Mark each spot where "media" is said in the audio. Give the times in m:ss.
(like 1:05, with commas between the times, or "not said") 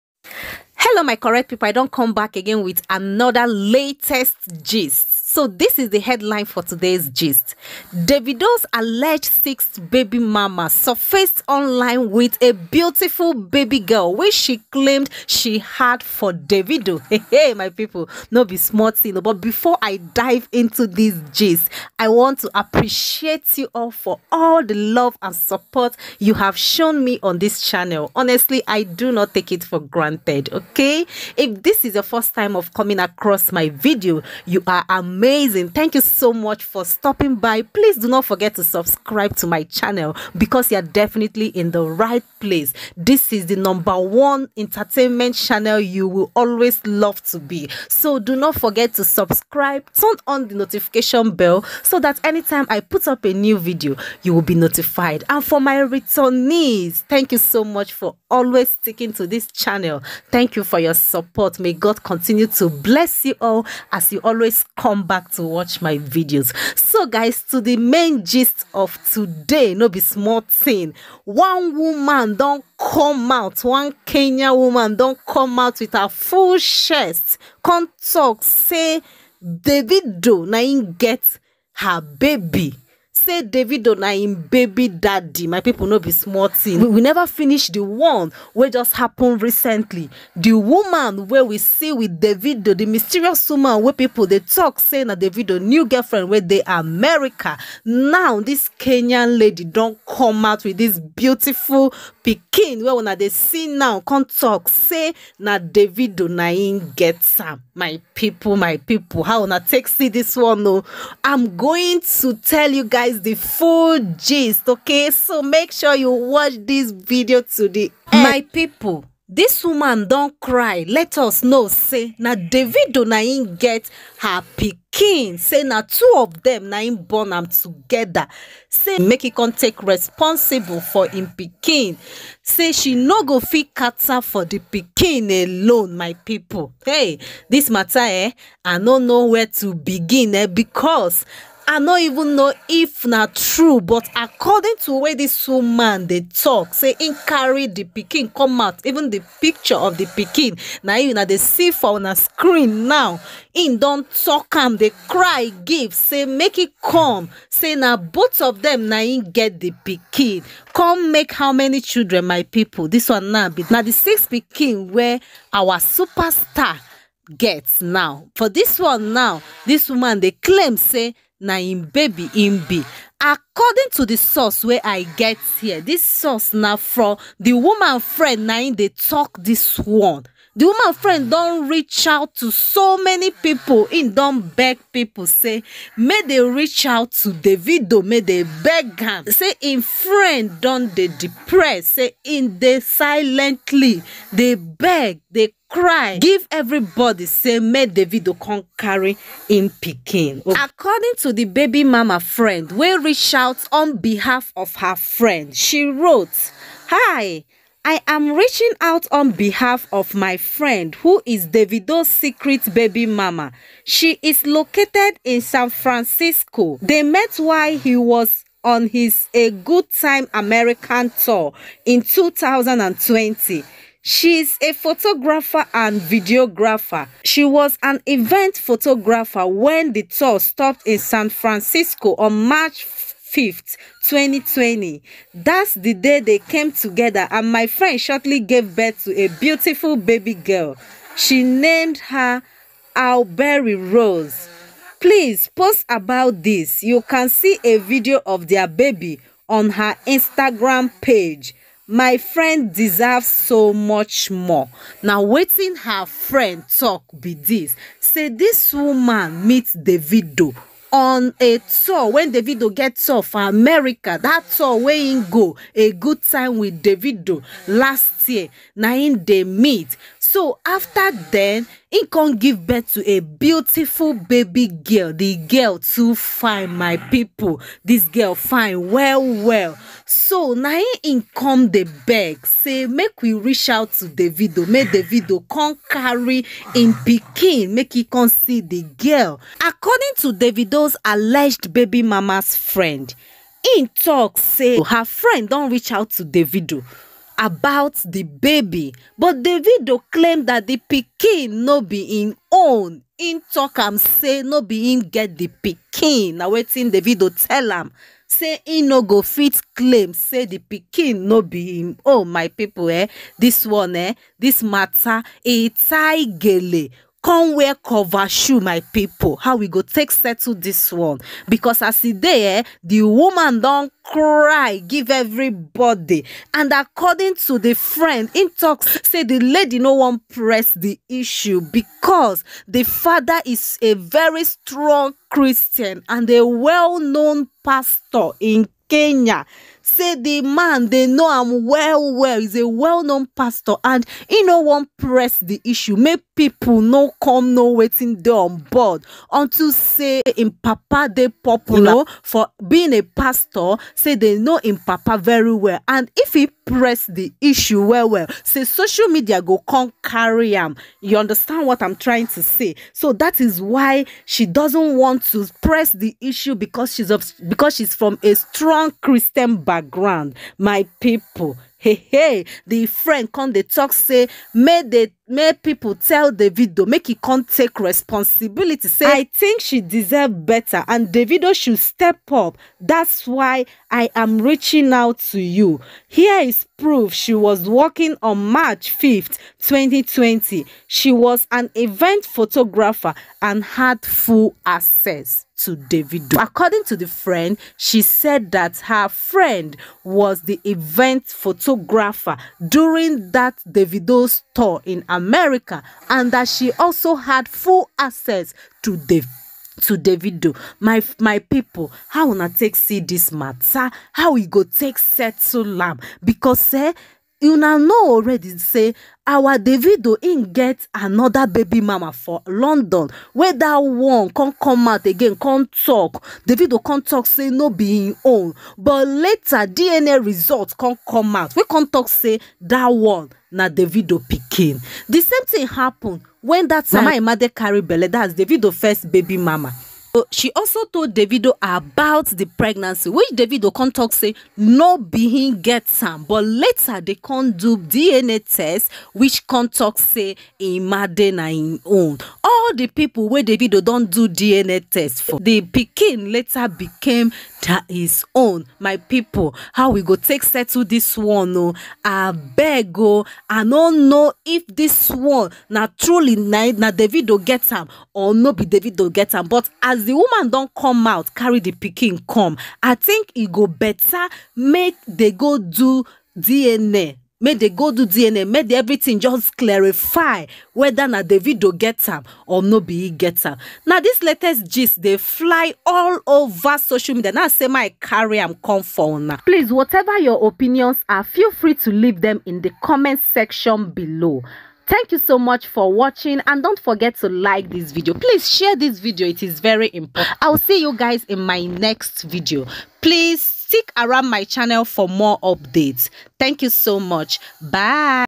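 5:59, 8:07.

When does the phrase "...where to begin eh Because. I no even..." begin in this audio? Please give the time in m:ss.
2:19.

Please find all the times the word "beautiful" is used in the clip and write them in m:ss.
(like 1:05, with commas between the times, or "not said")
0:12, 1:40, 3:59, 4:33.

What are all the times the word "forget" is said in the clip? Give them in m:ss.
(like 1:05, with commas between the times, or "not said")
0:38, 0:48, 8:16.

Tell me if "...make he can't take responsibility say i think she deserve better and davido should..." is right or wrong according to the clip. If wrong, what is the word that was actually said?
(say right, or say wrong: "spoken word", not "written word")
right.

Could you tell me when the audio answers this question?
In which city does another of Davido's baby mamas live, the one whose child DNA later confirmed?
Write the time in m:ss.
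7:02.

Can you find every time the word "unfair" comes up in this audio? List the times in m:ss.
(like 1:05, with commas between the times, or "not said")
not said.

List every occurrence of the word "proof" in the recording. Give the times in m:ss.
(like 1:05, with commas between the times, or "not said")
6:26.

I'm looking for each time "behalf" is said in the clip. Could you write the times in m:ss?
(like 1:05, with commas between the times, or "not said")
3:23, 3:29.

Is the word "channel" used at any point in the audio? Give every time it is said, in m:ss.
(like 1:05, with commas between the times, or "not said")
0:27, 0:39, 0:45, 0:59, 8:24.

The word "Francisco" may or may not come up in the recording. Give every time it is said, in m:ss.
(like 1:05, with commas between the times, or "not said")
3:35, 3:51.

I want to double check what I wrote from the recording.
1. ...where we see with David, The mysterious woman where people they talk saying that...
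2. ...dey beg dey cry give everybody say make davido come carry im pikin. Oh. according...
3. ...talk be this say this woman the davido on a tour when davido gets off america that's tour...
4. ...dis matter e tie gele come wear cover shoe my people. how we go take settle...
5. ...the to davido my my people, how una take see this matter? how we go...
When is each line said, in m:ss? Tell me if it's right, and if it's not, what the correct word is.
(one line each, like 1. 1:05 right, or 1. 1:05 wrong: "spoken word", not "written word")
1. 1:31 right
2. 3:14 right
3. 4:16 right
4. 5:14 right
5. 6:48 right.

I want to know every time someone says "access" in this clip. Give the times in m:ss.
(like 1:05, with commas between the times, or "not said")
6:34, 6:47.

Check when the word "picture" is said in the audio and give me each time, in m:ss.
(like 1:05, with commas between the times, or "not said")
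2:29.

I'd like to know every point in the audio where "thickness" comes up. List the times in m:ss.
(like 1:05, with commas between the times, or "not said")
not said.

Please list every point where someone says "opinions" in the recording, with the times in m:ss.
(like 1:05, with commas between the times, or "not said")
8:10.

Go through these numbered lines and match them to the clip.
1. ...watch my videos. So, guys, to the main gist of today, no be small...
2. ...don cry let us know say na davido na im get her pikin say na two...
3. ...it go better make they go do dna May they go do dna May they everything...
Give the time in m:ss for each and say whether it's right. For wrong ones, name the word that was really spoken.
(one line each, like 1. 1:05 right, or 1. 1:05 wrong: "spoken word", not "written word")
1. 1:05 right
2. 2:00 right
3. 7:53 right.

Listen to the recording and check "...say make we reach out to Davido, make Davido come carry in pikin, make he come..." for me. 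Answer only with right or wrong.
right.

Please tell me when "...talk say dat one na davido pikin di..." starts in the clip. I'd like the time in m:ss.
7:11.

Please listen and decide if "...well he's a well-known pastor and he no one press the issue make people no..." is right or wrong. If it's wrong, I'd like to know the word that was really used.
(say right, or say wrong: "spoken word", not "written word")
right.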